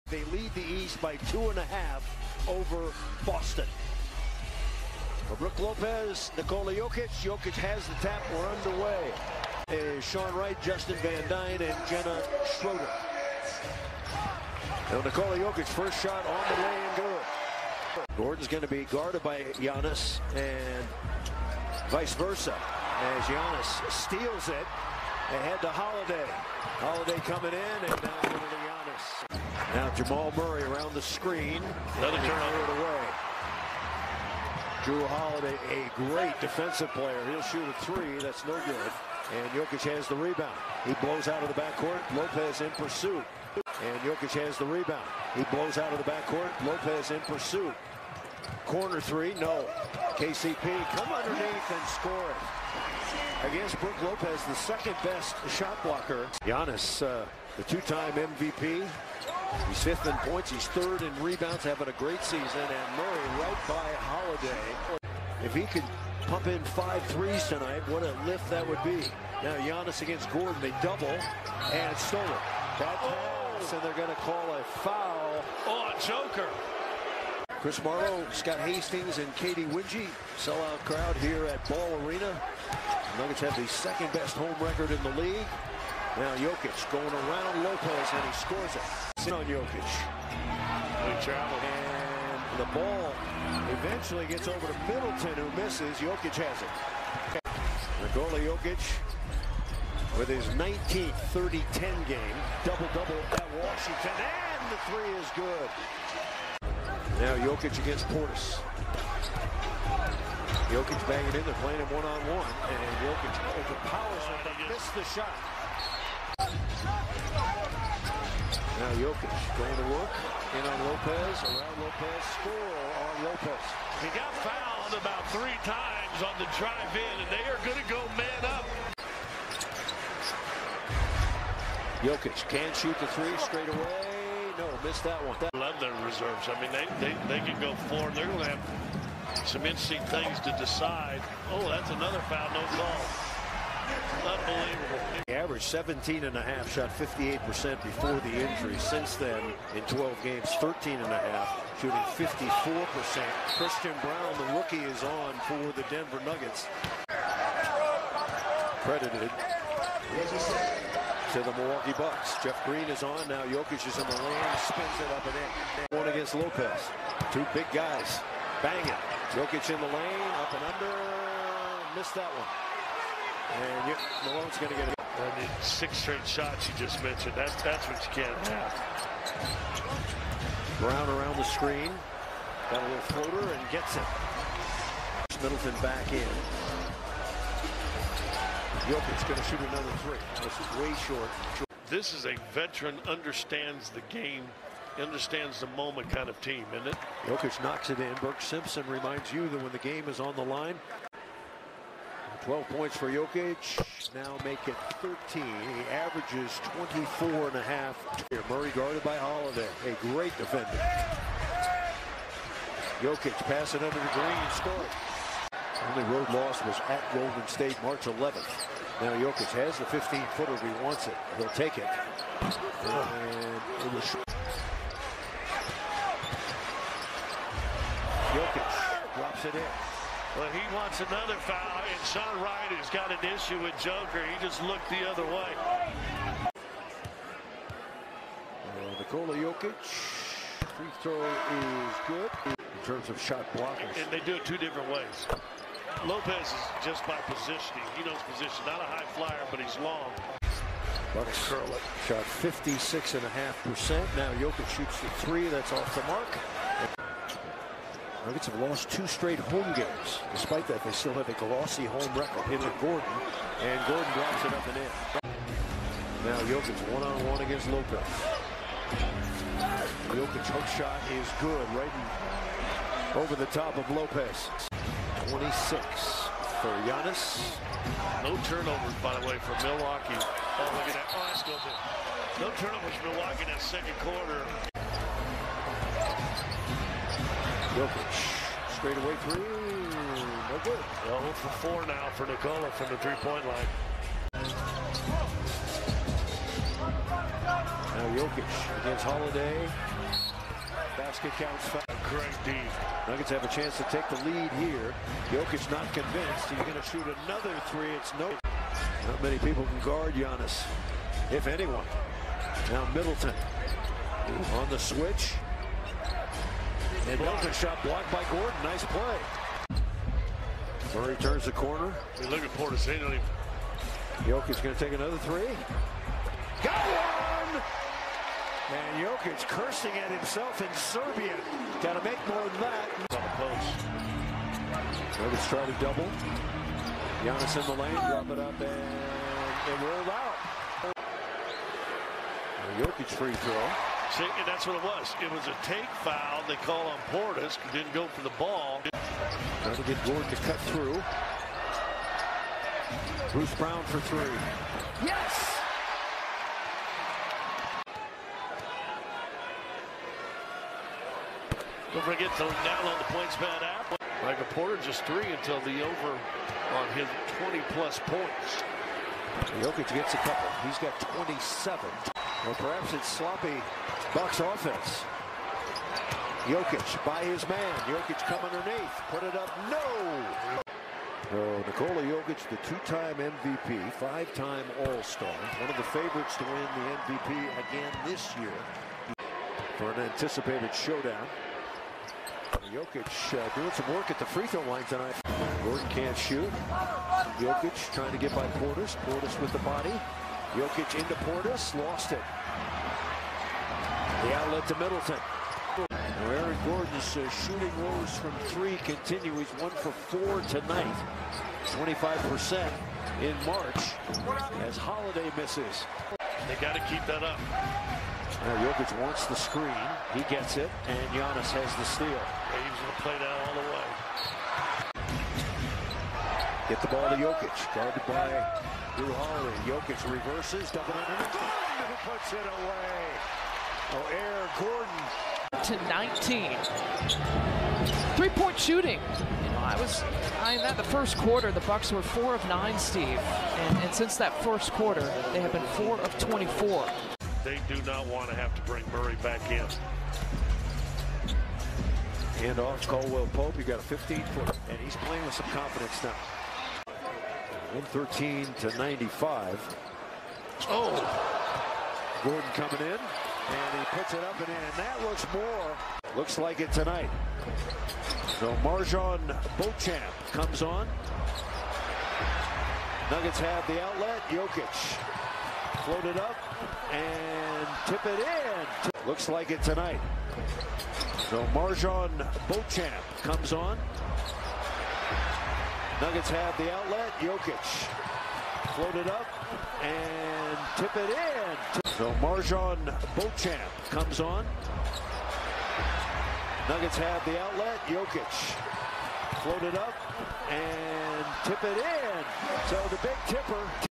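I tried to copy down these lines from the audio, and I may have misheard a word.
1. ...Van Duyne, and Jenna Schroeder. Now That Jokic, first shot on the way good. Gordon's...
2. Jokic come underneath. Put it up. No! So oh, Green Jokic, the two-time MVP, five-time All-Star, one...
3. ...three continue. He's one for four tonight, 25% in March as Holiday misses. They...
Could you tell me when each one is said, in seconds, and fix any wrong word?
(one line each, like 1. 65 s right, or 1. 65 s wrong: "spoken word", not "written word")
1. 10 s wrong: "Nikola", not "That"
2. 377 s wrong: "Nikola", not "Green"
3. 408 s right.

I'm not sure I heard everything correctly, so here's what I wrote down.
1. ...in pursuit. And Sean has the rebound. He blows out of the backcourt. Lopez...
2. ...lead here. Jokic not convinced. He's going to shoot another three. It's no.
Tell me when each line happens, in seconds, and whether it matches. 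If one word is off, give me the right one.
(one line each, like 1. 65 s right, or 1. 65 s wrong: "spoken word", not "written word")
1. 42 s wrong: "Jokic", not "Sean"
2. 304 s right.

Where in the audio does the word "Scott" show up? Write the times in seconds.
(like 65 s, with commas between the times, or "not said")
78 s.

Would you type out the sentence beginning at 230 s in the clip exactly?
Well, he wants another foul, and Sean Wright has got an issue with Joker.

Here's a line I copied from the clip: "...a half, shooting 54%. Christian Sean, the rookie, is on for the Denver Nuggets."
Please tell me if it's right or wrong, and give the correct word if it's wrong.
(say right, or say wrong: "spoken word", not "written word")
wrong: "Braun", not "Sean".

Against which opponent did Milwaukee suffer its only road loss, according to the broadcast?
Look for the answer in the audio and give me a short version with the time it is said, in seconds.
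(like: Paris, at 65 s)
Golden State, at 217 s.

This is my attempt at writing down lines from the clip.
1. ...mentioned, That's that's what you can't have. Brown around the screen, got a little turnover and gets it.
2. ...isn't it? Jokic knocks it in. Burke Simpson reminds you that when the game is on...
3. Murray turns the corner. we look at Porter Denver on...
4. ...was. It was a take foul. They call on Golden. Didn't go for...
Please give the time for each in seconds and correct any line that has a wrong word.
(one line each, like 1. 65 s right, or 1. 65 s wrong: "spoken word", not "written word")
1. 177 s wrong: "floater", not "turnover"
2. 196 s right
3. 320 s wrong: "State", not "Denver"
4. 344 s wrong: "Portis", not "Golden".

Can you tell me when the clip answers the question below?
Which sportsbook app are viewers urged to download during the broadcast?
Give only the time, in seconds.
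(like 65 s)
363 s.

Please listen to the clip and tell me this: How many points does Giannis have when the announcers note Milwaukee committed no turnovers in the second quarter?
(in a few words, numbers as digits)
26.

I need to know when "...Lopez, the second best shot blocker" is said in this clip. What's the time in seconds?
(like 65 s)
54 s.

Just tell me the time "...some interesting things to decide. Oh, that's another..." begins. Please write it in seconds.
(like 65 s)
139 s.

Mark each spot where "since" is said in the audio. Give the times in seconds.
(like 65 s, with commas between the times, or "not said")
148 s, 443 s.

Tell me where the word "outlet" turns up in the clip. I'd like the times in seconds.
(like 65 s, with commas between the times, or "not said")
404 s, 473 s, 486 s, 497 s.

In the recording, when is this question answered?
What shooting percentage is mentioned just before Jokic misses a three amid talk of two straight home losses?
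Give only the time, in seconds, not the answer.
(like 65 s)
252 s.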